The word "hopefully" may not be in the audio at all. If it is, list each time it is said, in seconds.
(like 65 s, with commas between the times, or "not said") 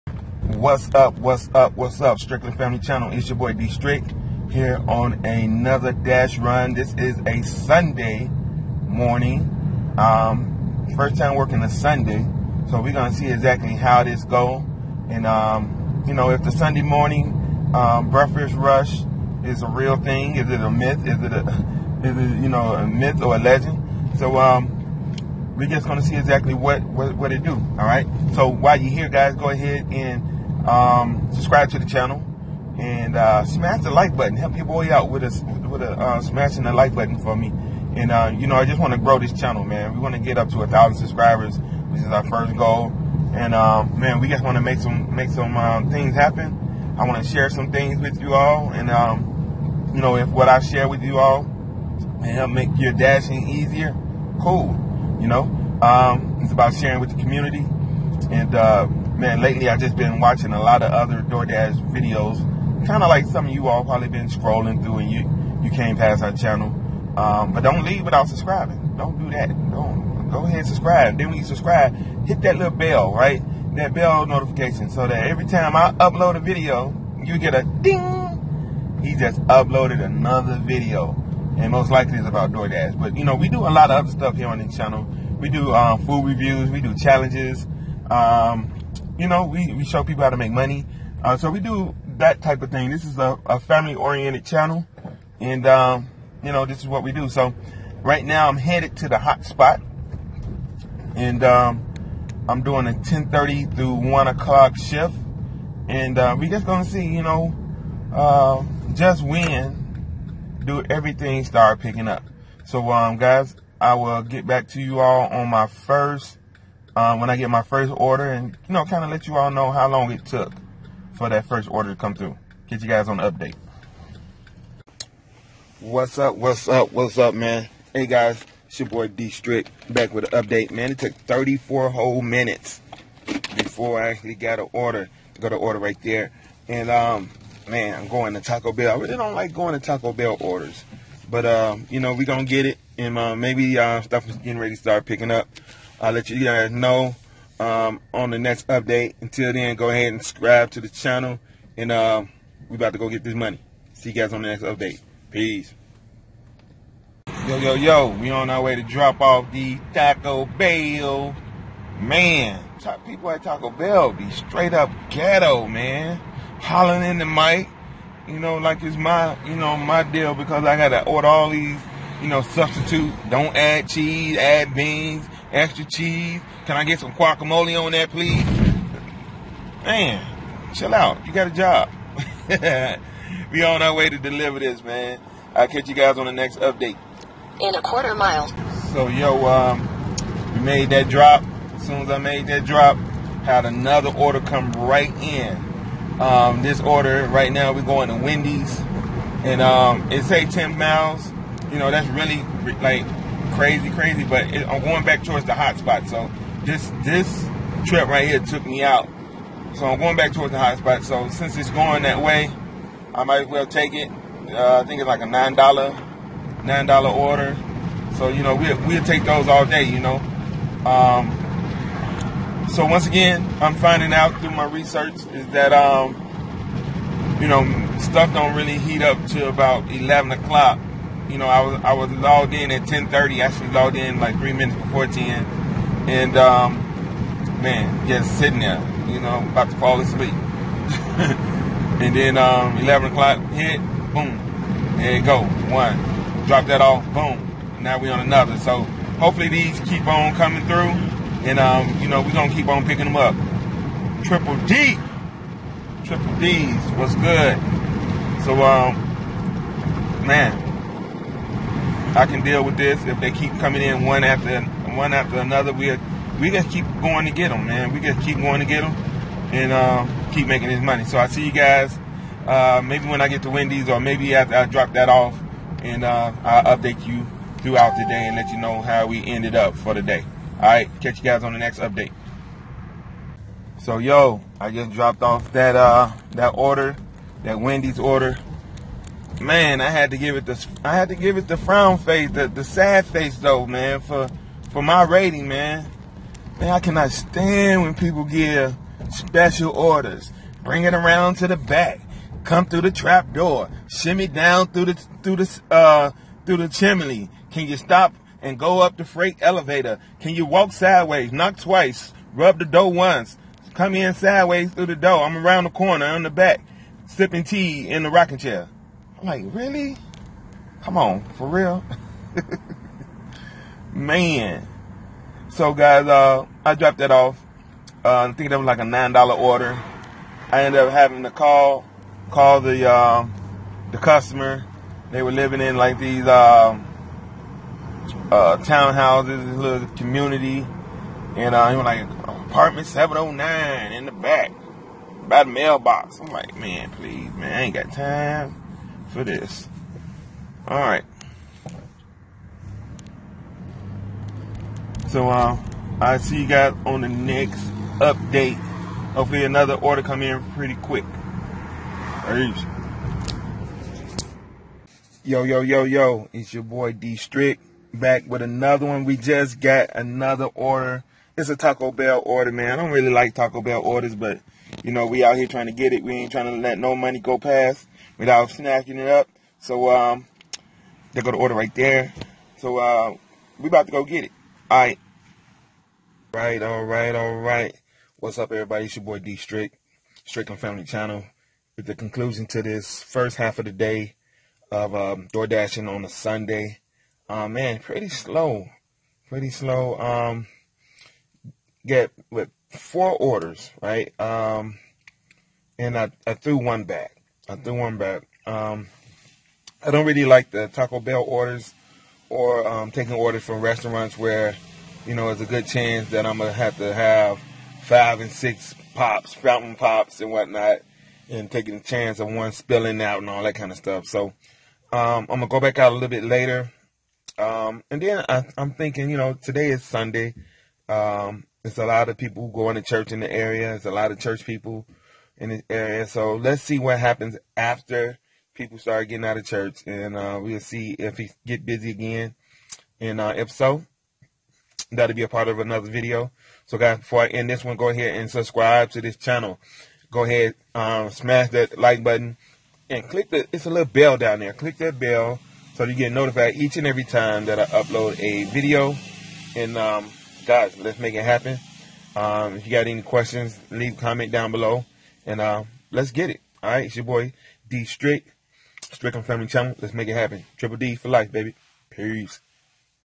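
249 s, 359 s.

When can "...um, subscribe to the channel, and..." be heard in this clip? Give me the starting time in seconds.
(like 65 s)
30 s.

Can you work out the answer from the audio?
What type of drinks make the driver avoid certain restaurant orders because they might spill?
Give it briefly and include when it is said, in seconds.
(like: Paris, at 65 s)
fountain pops, at 419 s.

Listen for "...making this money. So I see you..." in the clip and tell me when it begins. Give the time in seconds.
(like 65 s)
270 s.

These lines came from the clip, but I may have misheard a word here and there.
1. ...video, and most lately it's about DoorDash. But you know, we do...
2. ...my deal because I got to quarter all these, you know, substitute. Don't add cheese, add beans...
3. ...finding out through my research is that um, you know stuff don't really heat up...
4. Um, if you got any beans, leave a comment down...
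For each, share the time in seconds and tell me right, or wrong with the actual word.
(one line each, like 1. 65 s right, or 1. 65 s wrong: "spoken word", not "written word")
1. 80 s wrong: "likely", not "lately"
2. 169 s wrong: "order", not "quarter"
3. 223 s right
4. 462 s wrong: "questions", not "beans".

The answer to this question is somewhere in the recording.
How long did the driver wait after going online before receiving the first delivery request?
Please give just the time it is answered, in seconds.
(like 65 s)
131 s.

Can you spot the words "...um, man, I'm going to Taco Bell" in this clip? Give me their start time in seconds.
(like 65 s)
136 s.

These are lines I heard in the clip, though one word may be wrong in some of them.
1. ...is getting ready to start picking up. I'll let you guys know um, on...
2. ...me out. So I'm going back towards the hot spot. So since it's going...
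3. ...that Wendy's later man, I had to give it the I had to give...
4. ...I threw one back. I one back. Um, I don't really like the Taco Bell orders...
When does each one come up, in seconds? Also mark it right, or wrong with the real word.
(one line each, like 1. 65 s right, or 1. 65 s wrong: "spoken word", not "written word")
1. 144 s right
2. 208 s right
3. 287 s wrong: "order", not "later"
4. 406 s right.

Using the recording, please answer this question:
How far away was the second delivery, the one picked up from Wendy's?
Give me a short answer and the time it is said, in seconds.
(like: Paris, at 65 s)
10 miles, at 200 s.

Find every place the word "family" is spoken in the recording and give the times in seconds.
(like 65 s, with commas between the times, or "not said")
2 s, 93 s, 390 s, 469 s.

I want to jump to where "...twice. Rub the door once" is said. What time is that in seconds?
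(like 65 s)
311 s.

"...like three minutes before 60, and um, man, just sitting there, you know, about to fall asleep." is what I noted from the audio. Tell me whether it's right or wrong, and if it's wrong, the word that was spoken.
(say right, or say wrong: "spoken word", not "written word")
wrong: "10", not "60".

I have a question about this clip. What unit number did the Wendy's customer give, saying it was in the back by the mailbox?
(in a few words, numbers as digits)
709.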